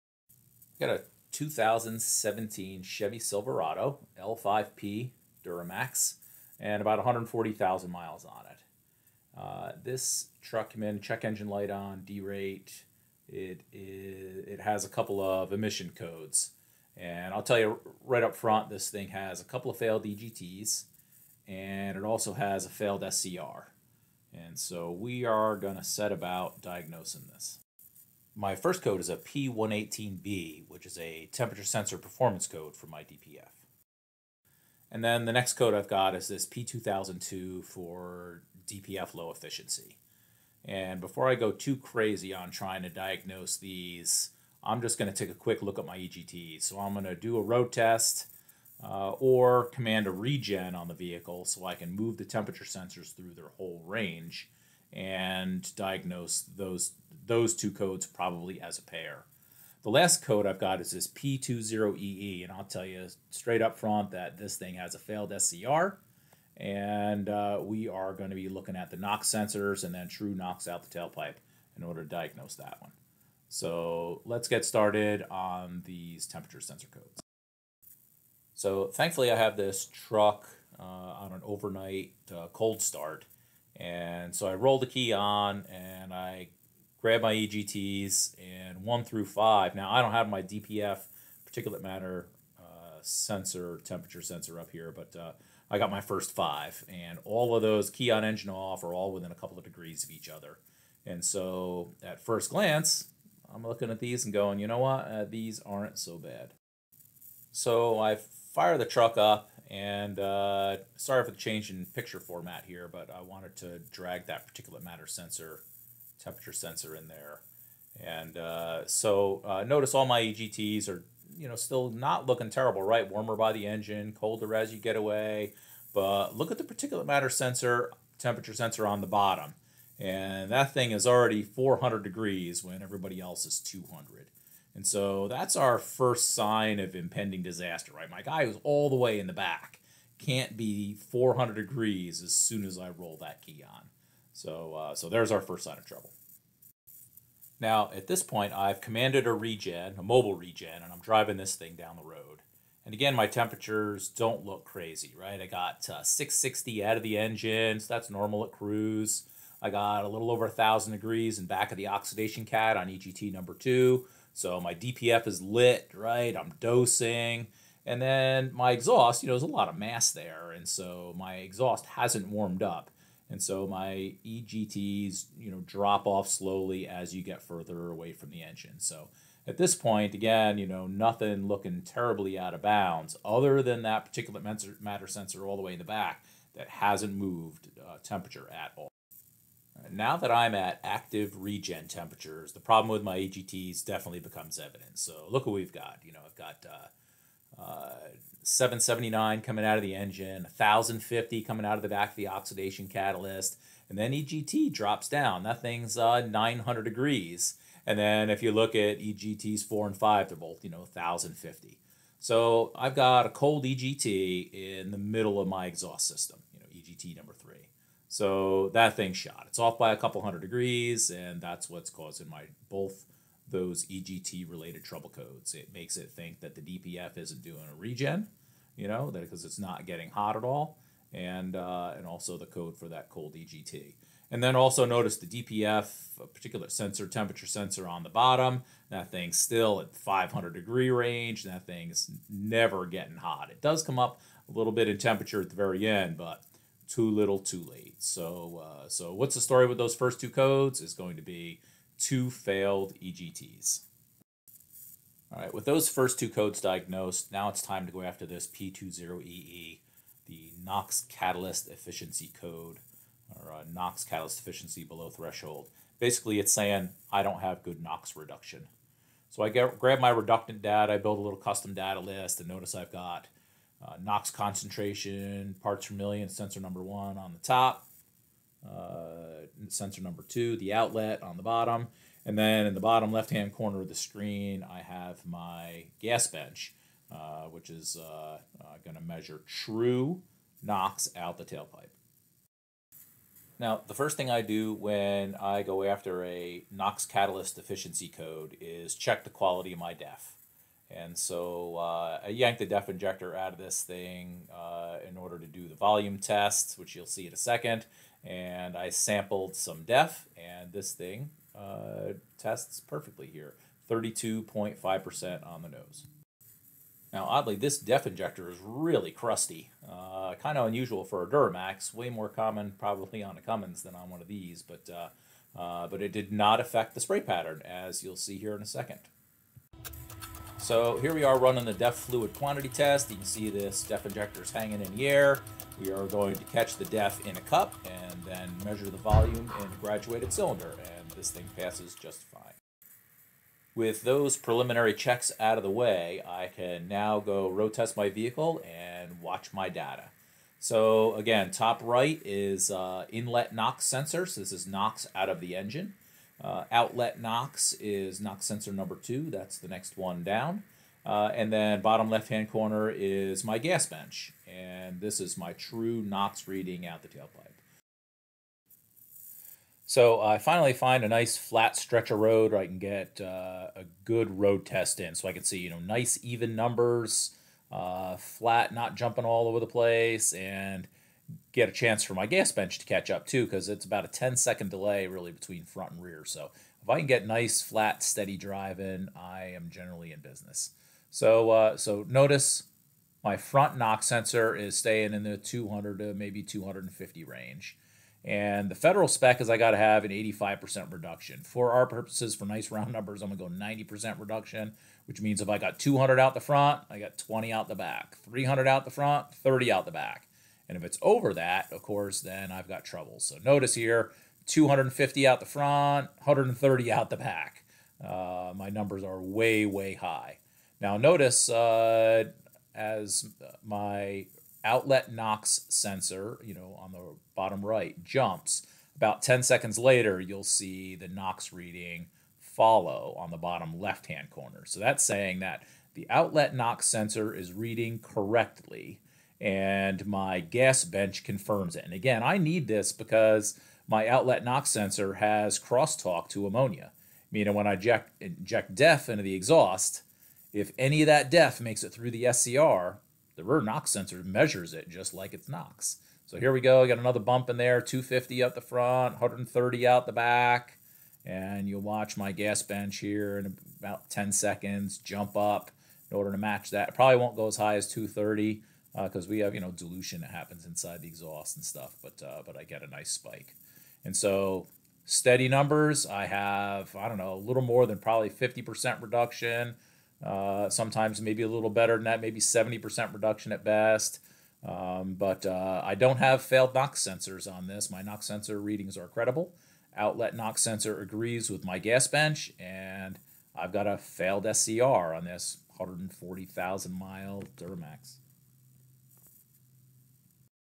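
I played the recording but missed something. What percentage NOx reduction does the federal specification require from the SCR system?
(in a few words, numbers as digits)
85%.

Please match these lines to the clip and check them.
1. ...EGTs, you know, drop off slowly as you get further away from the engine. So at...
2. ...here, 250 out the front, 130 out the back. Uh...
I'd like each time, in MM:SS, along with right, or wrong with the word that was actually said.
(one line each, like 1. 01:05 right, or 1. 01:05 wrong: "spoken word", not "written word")
1. 02:54 right
2. 06:53 right.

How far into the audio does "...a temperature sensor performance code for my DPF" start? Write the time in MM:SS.
00:30.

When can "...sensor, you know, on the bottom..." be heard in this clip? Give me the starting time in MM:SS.
07:05.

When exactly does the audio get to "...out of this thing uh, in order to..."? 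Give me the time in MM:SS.
05:03.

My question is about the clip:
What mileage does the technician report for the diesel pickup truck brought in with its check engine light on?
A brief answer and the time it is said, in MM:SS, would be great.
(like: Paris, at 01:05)
140,000 miles, at 00:06.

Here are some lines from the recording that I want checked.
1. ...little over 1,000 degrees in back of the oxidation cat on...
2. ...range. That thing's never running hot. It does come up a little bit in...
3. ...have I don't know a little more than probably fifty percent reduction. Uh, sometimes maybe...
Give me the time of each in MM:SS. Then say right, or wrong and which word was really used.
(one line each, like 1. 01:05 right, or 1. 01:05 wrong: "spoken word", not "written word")
1. 02:40 right
2. 04:00 wrong: "getting", not "running"
3. 07:56 right.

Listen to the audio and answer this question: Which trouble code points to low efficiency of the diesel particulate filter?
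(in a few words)
P2002.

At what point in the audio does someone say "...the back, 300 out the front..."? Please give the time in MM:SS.
06:47.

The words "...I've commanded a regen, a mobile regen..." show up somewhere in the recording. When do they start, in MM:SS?
02:28.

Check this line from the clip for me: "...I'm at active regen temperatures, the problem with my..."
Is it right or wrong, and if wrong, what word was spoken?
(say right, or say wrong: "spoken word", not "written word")
right.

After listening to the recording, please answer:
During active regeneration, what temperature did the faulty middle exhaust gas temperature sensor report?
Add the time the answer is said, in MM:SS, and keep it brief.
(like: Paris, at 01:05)
900 degrees, at 03:26.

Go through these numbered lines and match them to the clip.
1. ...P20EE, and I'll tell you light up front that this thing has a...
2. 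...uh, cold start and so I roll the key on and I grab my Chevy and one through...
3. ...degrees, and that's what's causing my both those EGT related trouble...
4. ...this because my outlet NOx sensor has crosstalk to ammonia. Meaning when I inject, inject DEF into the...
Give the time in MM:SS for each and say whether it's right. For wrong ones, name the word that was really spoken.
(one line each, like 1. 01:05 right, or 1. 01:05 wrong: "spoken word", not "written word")
1. 01:01 wrong: "straight", not "light"
2. 01:22 wrong: "EGTs", not "Chevy"
3. 03:40 right
4. 07:22 right.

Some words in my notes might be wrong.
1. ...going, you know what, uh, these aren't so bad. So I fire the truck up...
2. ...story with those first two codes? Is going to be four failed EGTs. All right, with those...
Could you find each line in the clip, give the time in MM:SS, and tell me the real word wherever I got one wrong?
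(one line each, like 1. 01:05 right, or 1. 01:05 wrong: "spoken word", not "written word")
1. 01:44 right
2. 04:09 wrong: "two", not "four".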